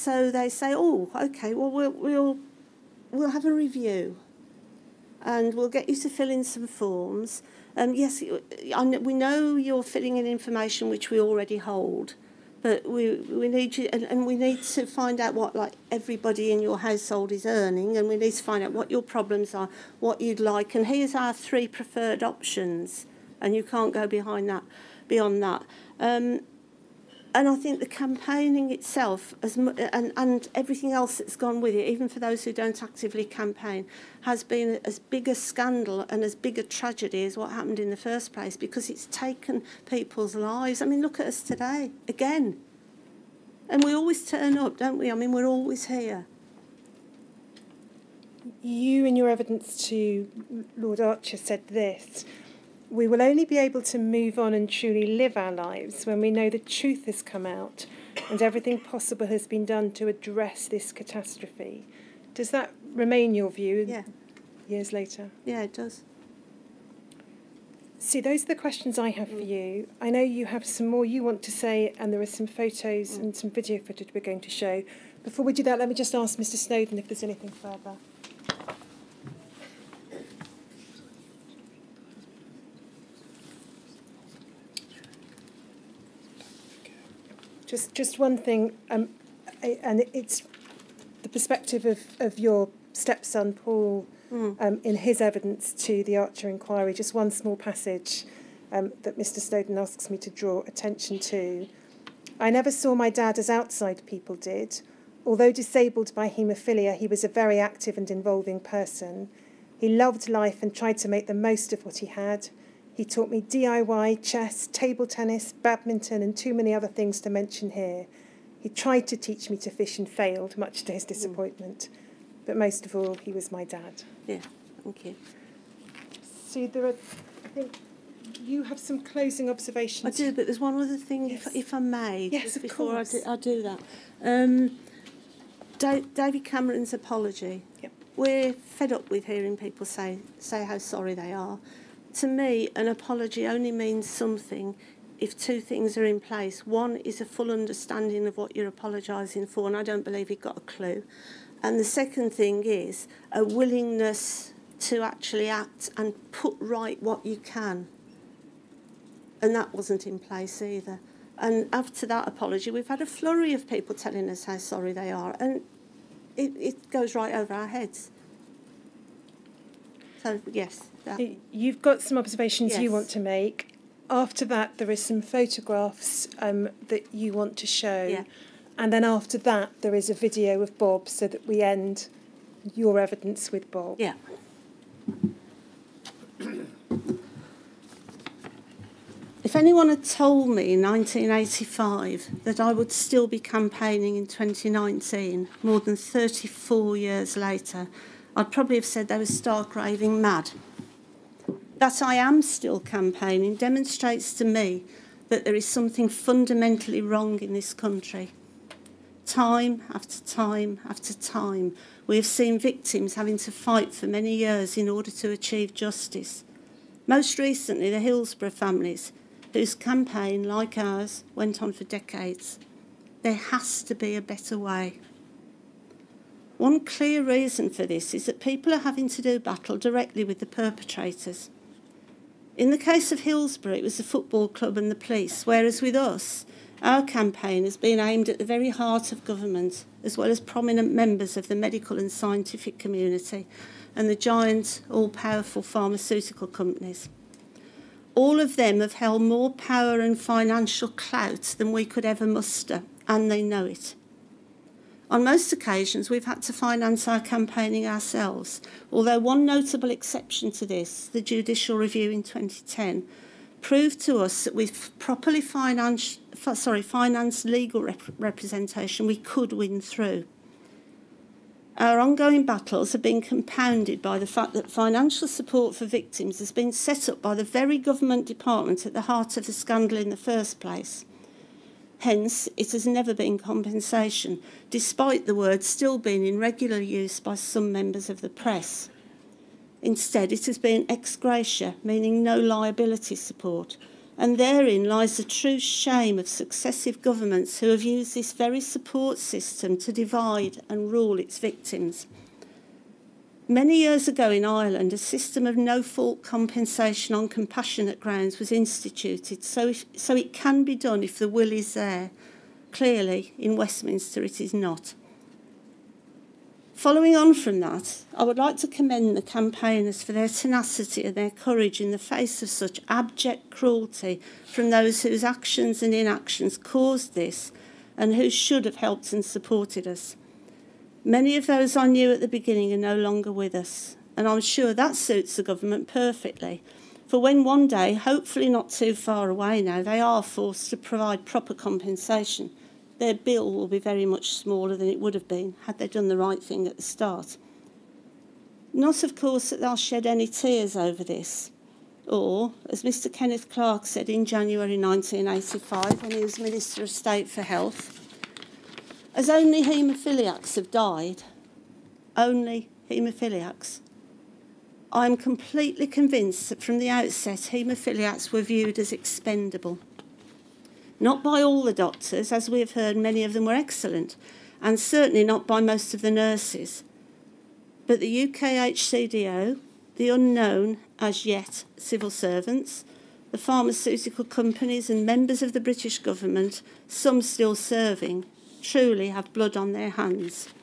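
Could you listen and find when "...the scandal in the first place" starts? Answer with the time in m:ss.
4:39.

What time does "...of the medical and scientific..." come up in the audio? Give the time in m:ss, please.
4:01.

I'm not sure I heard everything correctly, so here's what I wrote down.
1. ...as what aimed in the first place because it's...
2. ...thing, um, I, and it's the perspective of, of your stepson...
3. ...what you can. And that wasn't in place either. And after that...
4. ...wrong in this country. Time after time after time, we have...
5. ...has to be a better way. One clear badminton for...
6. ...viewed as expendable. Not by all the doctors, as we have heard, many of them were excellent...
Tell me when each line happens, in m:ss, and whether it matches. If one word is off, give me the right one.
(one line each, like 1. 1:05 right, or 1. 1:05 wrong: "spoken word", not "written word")
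1. 0:37 wrong: "happened", not "aimed"
2. 1:28 right
3. 2:37 right
4. 3:27 right
5. 3:43 wrong: "reason", not "badminton"
6. 6:08 right.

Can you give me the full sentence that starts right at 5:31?
Many of those I knew at the beginning are no longer with us, and I'm sure that suits the government perfectly.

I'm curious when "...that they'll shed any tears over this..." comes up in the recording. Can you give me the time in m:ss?
5:49.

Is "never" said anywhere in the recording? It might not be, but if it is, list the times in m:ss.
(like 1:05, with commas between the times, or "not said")
1:42, 4:42.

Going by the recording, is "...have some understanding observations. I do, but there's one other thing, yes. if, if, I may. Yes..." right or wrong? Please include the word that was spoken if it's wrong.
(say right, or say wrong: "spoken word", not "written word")
wrong: "closing", not "understanding".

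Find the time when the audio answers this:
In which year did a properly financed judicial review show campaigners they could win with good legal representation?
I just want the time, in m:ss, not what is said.
4:22.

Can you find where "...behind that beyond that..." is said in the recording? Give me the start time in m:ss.
0:24.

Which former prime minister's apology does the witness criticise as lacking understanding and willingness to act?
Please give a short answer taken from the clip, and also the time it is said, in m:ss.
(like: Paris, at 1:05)
David Cameron, at 2:16.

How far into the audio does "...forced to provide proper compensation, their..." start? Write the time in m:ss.
5:40.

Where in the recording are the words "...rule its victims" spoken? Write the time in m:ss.
5:00.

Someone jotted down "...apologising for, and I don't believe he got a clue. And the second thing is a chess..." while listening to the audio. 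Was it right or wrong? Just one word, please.
wrong.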